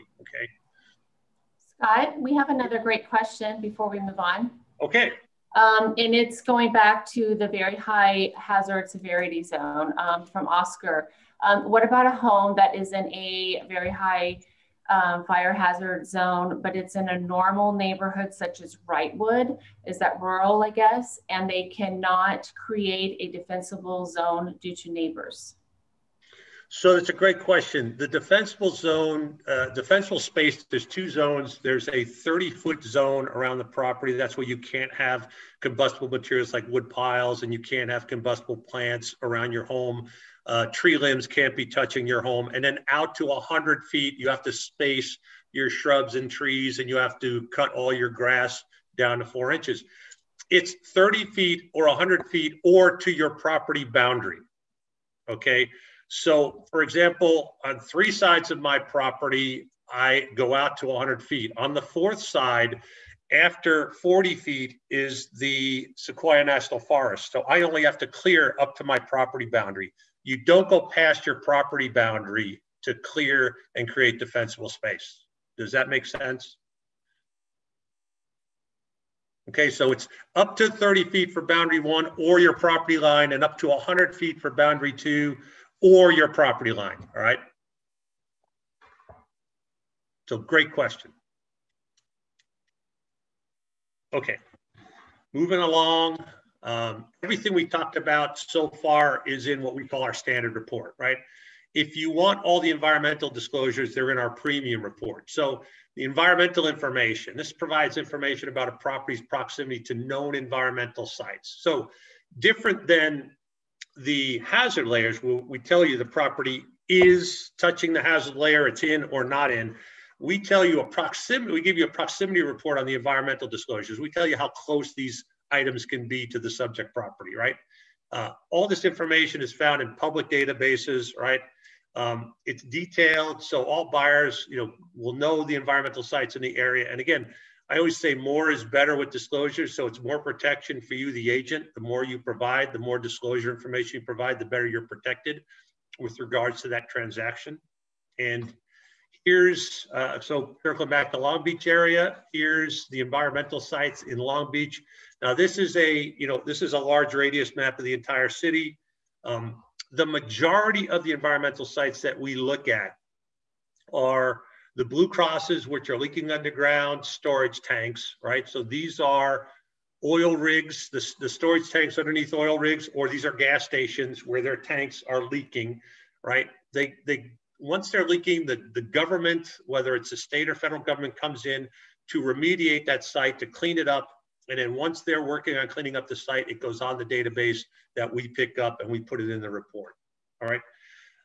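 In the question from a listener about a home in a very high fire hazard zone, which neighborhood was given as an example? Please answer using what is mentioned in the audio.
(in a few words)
Wrightwood.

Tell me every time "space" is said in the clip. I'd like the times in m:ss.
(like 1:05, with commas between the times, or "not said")
0:30, 0:44, 1:14.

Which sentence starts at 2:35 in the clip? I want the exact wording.
Now this is a, you know, this is a large radius map of the entire city.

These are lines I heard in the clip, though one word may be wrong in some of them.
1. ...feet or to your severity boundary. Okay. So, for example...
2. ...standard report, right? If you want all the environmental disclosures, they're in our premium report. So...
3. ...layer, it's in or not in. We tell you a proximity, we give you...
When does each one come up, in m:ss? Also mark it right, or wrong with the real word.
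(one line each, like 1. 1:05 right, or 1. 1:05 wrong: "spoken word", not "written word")
1. 0:52 wrong: "property", not "severity"
2. 1:40 right
3. 1:58 right.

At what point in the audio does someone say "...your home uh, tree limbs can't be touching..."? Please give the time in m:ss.
0:39.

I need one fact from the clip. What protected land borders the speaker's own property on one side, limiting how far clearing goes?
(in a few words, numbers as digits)
Sequoia National Forest.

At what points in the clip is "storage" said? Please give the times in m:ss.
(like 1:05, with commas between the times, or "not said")
2:47, 2:51.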